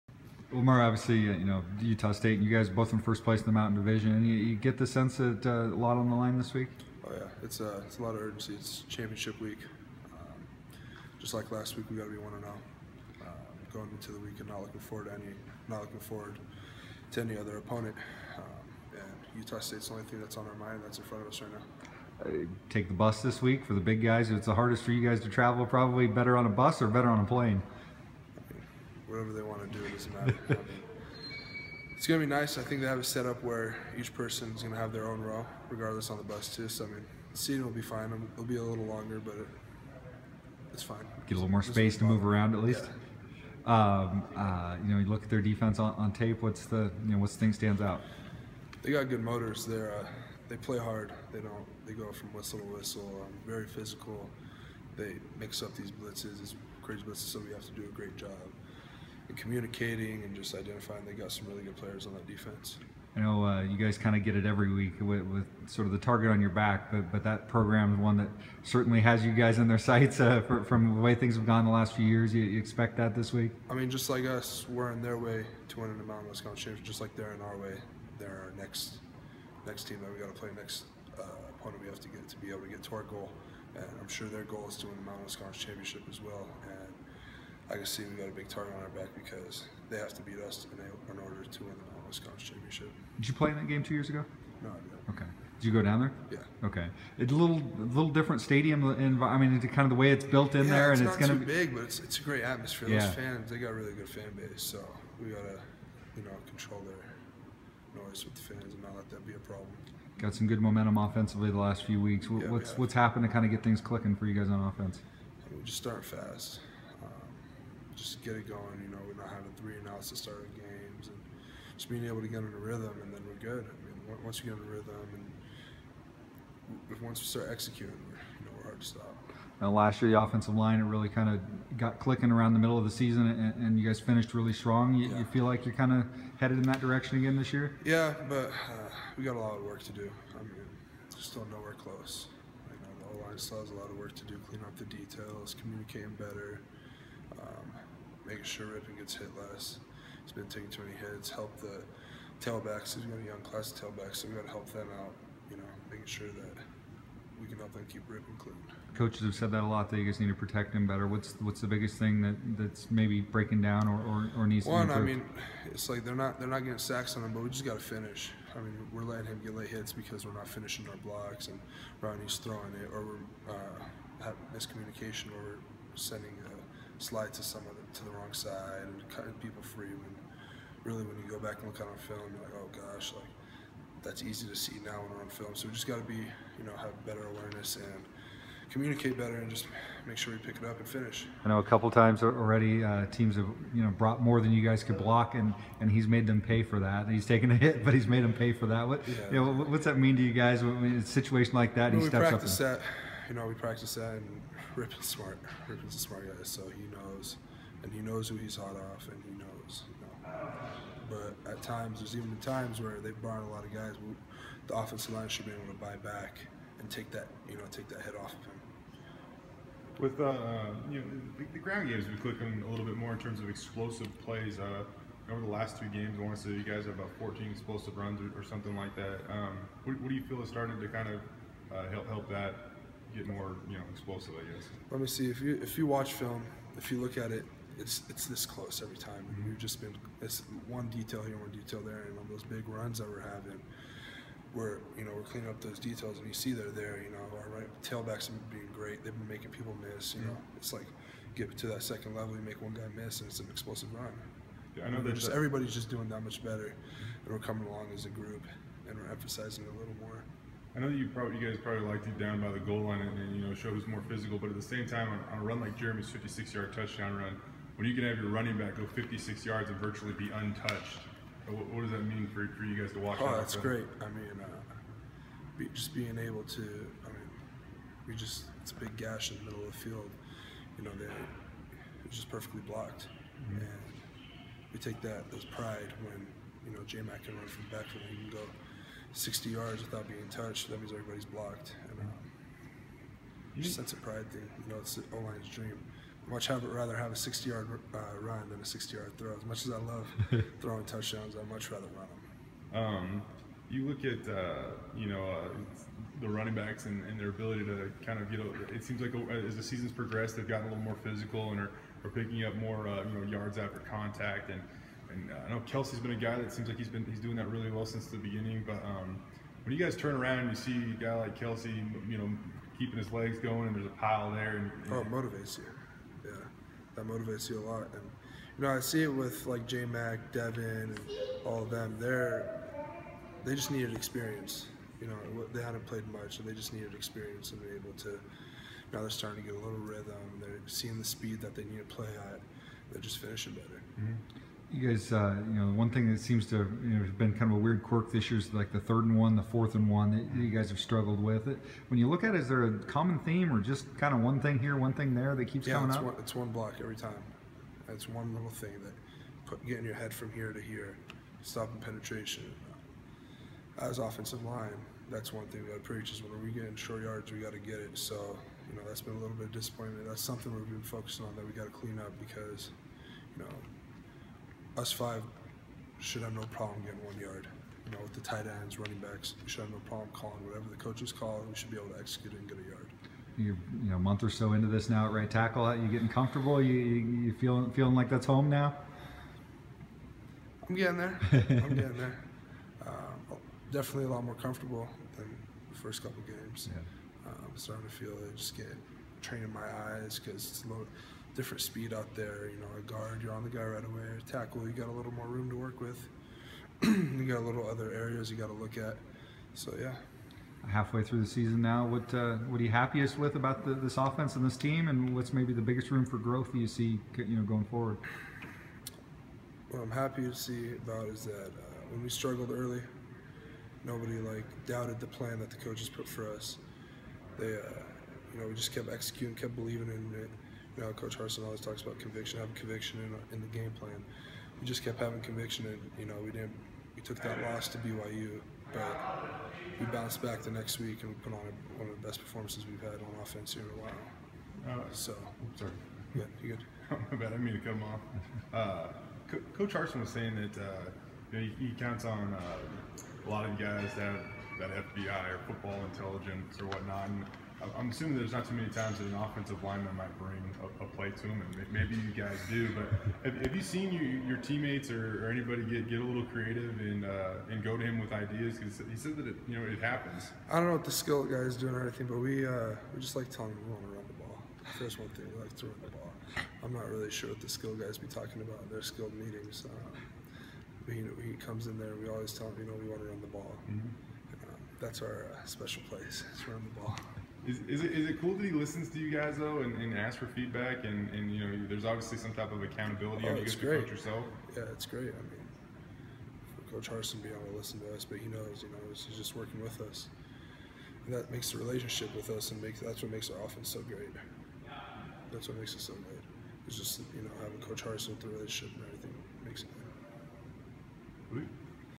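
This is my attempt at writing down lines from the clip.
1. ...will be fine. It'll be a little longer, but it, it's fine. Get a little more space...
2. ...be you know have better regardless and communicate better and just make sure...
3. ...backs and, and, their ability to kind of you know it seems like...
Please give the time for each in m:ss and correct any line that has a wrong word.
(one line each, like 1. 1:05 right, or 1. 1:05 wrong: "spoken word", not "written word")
1. 0:37 right
2. 3:06 wrong: "awareness", not "regardless"
3. 5:06 right.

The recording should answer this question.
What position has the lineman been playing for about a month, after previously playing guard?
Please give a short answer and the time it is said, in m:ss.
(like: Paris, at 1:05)
Right tackle, at 6:25.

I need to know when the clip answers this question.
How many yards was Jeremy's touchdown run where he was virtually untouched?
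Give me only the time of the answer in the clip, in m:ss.
4:26.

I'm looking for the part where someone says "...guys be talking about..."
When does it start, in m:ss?
7:57.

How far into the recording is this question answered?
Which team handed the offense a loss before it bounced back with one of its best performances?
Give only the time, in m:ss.
7:17.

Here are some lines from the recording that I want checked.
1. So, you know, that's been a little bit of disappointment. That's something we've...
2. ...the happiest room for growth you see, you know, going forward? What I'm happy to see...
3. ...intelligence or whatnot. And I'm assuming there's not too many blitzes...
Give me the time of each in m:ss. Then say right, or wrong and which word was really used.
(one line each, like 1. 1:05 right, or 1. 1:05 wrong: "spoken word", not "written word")
1. 6:07 right
2. 6:55 wrong: "biggest", not "happiest"
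3. 7:35 wrong: "times", not "blitzes".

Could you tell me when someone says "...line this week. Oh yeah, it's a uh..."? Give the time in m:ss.
0:06.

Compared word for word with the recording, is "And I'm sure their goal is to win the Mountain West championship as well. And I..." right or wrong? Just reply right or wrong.
right.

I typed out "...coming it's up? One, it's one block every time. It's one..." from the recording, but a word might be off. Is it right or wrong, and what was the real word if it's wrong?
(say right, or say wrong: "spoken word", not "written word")
right.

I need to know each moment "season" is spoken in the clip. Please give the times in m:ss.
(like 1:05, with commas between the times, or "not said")
2:12, 5:09, 6:51.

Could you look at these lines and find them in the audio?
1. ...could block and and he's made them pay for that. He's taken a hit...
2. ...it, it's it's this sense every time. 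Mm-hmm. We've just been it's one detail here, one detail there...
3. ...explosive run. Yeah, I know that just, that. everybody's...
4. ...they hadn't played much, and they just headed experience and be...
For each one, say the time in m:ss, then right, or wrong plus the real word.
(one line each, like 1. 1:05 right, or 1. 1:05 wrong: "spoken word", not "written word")
1. 3:14 right
2. 3:57 wrong: "close", not "sense"
3. 4:13 right
4. 5:35 wrong: "needed", not "headed".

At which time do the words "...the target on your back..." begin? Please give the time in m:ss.
1:05.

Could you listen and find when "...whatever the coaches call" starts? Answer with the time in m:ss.
6:20.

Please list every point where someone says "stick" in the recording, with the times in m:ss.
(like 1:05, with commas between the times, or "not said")
not said.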